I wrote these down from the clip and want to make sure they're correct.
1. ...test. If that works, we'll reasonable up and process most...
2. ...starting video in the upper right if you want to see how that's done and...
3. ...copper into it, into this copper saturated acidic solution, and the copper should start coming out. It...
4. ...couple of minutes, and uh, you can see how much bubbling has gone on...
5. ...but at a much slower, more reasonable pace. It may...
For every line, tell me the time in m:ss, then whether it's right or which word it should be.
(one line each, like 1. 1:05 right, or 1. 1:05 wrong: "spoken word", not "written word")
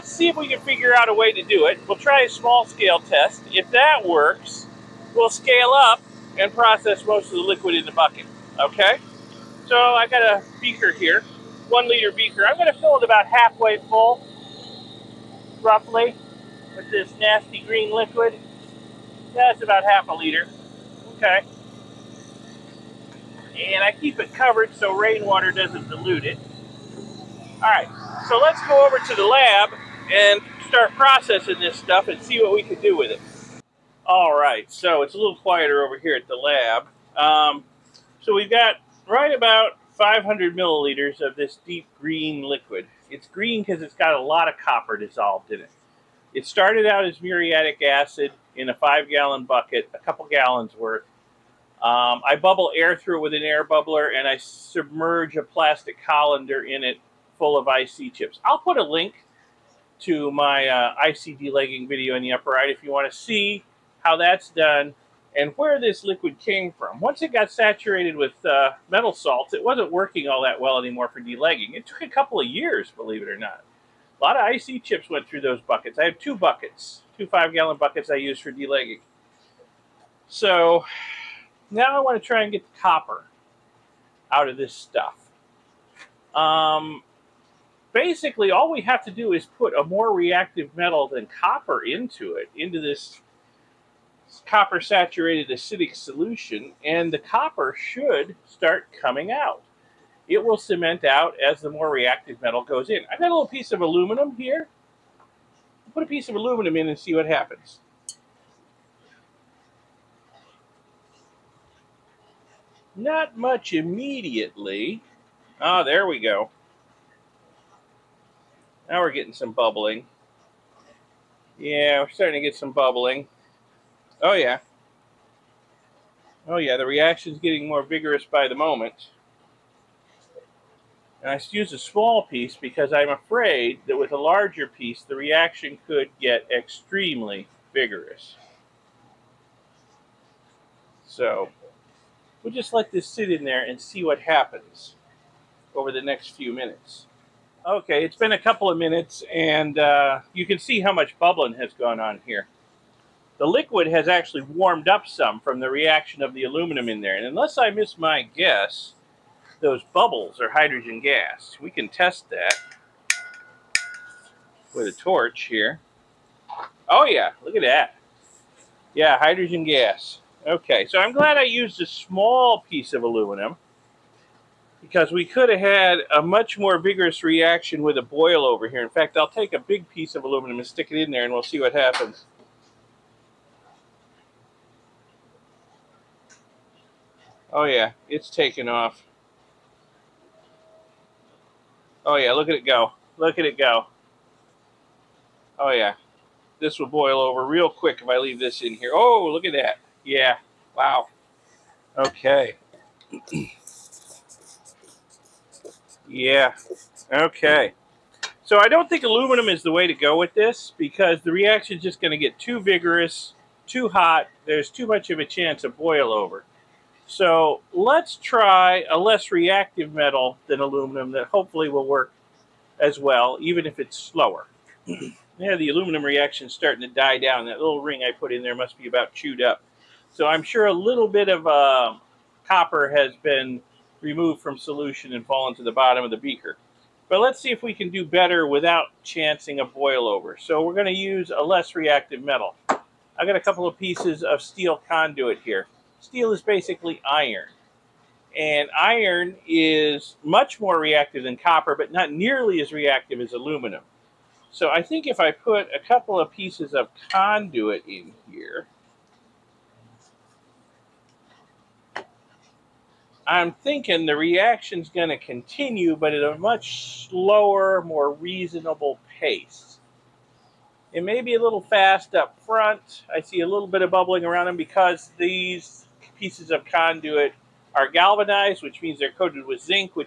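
1. 0:02 wrong: "scale", not "reasonable"
2. 1:01 wrong: "delegging", not "starting"
3. 1:31 right
4. 2:28 right
5. 4:25 right.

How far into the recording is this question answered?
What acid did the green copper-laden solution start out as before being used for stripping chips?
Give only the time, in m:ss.
0:47.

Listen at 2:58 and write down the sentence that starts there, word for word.
In fact, I'll take a big piece of aluminum and stick it in there and we'll see what happens.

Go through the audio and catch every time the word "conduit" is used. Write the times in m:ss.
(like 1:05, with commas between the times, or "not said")
4:04, 4:17, 4:36.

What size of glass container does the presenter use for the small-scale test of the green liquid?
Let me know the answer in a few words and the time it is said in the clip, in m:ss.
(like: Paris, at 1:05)
1 liter, at 0:11.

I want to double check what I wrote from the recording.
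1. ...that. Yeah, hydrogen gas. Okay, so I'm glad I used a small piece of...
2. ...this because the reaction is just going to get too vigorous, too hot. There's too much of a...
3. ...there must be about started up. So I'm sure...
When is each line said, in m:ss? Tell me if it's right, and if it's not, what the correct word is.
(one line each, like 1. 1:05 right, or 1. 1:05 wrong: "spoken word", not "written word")
1. 2:47 right
2. 3:30 right
3. 3:48 wrong: "chewed", not "started".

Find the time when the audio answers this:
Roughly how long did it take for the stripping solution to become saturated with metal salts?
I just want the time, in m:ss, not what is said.
1:12.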